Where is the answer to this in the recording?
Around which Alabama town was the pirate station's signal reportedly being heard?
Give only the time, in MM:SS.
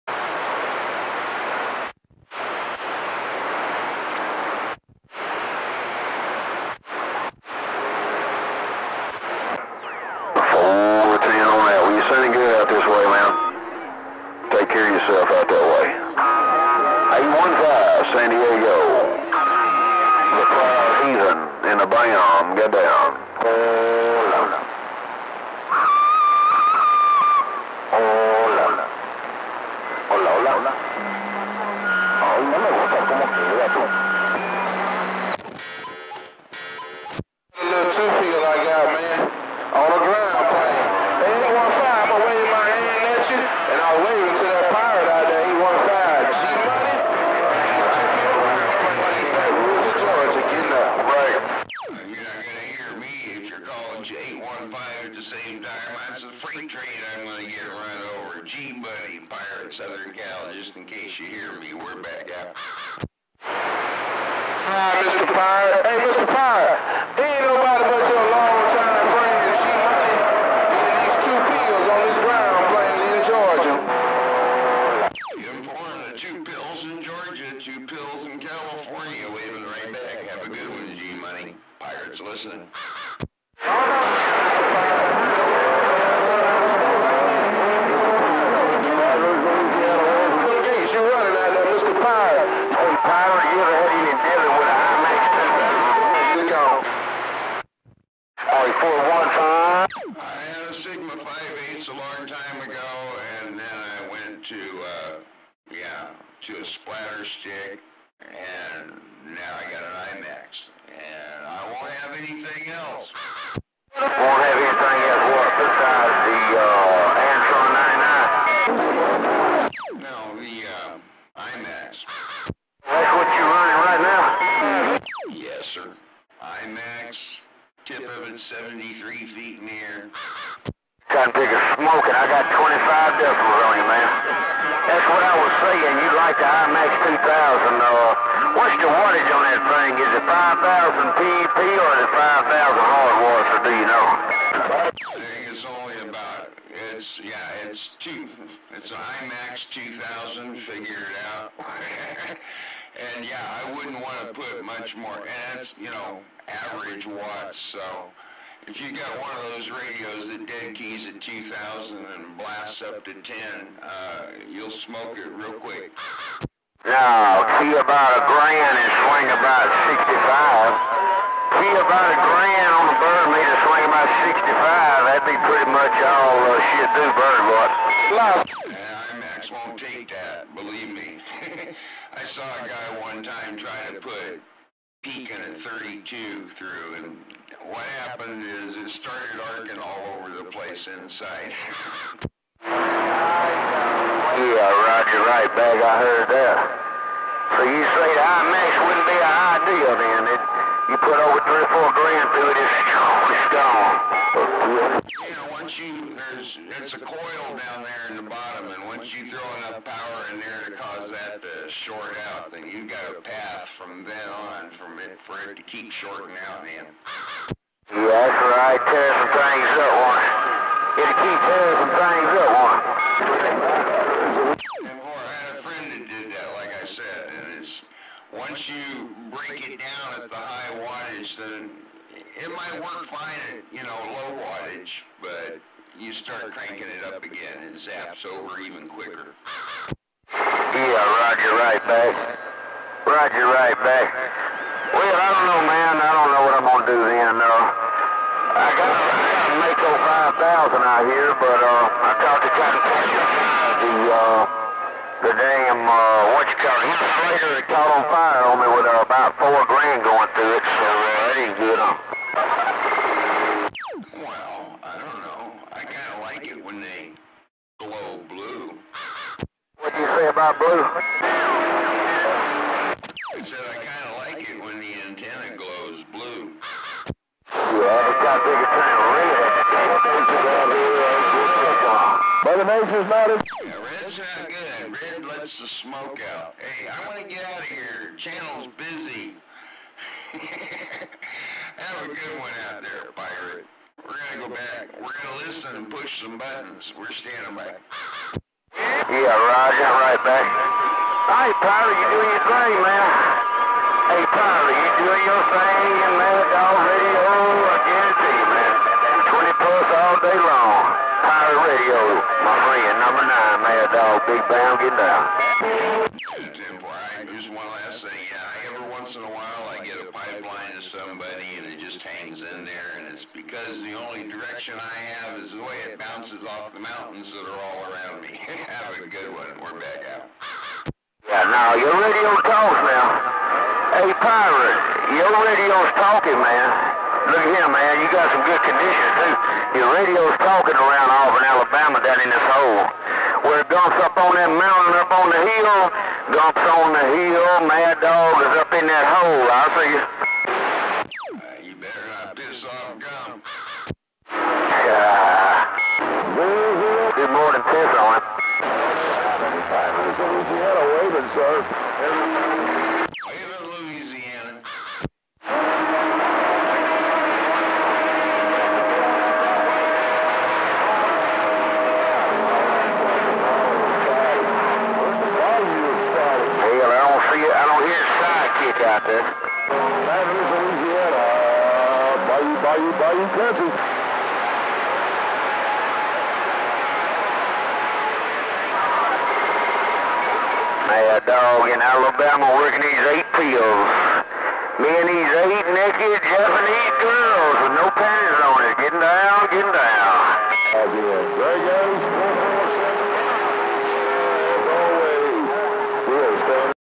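05:41.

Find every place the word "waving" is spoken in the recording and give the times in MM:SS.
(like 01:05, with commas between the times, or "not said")
01:19, 06:00.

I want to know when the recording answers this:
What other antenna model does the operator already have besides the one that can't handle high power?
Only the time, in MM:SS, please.
04:09.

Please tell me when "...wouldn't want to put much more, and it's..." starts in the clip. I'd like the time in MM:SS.
02:33.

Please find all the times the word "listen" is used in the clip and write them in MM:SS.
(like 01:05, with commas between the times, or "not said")
01:22, 04:55.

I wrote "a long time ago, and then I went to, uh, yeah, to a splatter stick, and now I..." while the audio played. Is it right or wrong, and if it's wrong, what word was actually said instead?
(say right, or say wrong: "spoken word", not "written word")
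right.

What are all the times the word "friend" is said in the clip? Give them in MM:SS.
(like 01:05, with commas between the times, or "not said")
01:09, 03:45, 05:12.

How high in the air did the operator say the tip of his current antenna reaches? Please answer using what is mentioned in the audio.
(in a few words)
73 feet.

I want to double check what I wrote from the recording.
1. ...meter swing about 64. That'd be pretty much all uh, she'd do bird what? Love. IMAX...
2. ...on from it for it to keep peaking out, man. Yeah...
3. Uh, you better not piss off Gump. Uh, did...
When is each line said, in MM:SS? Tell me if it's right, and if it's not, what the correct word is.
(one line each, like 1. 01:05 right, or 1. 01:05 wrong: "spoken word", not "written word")
1. 02:53 wrong: "65", not "64"
2. 03:34 wrong: "shorting", not "peaking"
3. 05:51 right.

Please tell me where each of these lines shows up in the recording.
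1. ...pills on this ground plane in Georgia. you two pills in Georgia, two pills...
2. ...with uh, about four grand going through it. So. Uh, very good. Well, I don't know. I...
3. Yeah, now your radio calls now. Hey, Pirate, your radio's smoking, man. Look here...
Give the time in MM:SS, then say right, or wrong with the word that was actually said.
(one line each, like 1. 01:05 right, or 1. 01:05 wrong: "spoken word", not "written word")
1. 01:16 right
2. 04:18 right
3. 05:31 wrong: "talking", not "smoking".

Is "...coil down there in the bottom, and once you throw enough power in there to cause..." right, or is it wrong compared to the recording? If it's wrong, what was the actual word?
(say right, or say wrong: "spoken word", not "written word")
right.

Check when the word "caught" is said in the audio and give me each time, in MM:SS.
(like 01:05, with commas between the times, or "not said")
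04:17.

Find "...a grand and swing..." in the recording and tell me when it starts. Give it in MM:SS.
02:48.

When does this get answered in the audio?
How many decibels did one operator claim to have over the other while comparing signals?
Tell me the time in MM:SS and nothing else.
02:12.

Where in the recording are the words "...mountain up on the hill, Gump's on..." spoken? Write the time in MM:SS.
05:44.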